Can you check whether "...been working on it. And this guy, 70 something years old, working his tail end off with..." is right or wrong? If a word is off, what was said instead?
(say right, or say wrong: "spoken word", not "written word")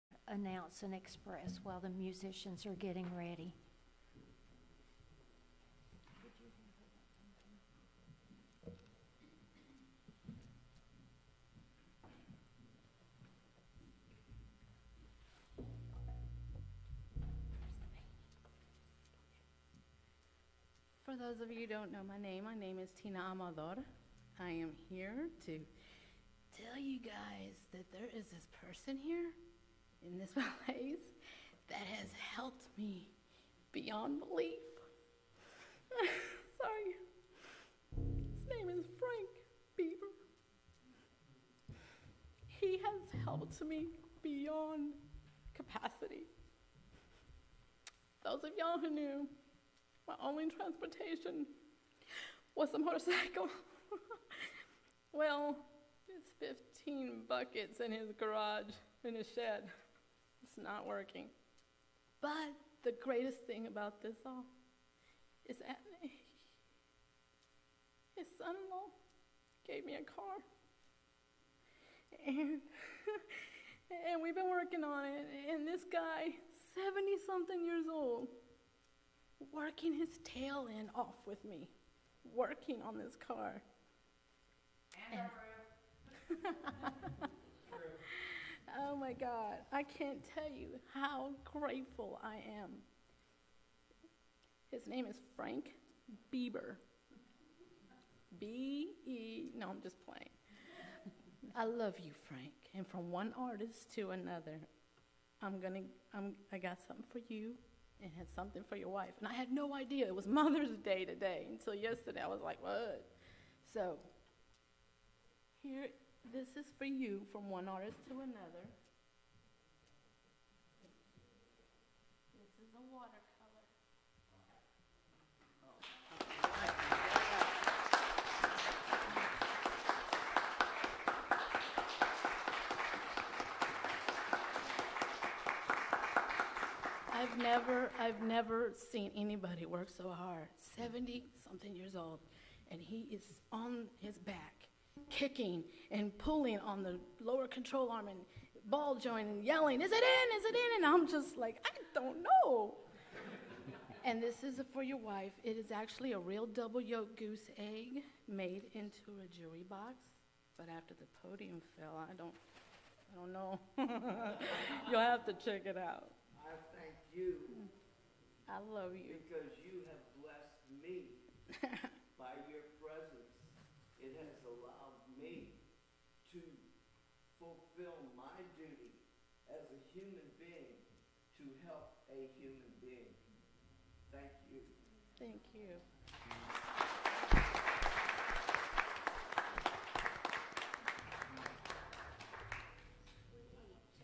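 right.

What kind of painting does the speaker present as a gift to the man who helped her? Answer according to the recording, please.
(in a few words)
watercolor.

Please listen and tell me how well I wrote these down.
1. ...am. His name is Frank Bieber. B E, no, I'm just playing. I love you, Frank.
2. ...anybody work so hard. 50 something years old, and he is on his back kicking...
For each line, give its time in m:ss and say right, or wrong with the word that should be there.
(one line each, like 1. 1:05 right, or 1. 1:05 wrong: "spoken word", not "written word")
1. 1:32 right
2. 2:19 wrong: "70", not "50".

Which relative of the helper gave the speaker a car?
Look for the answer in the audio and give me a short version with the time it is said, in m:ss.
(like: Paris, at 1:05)
son in law, at 1:08.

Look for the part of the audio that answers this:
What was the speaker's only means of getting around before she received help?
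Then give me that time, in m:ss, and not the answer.
0:52.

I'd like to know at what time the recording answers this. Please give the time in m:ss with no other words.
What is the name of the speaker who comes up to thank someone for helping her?
0:22.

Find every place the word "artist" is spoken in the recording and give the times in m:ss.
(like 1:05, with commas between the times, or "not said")
1:43, 1:57.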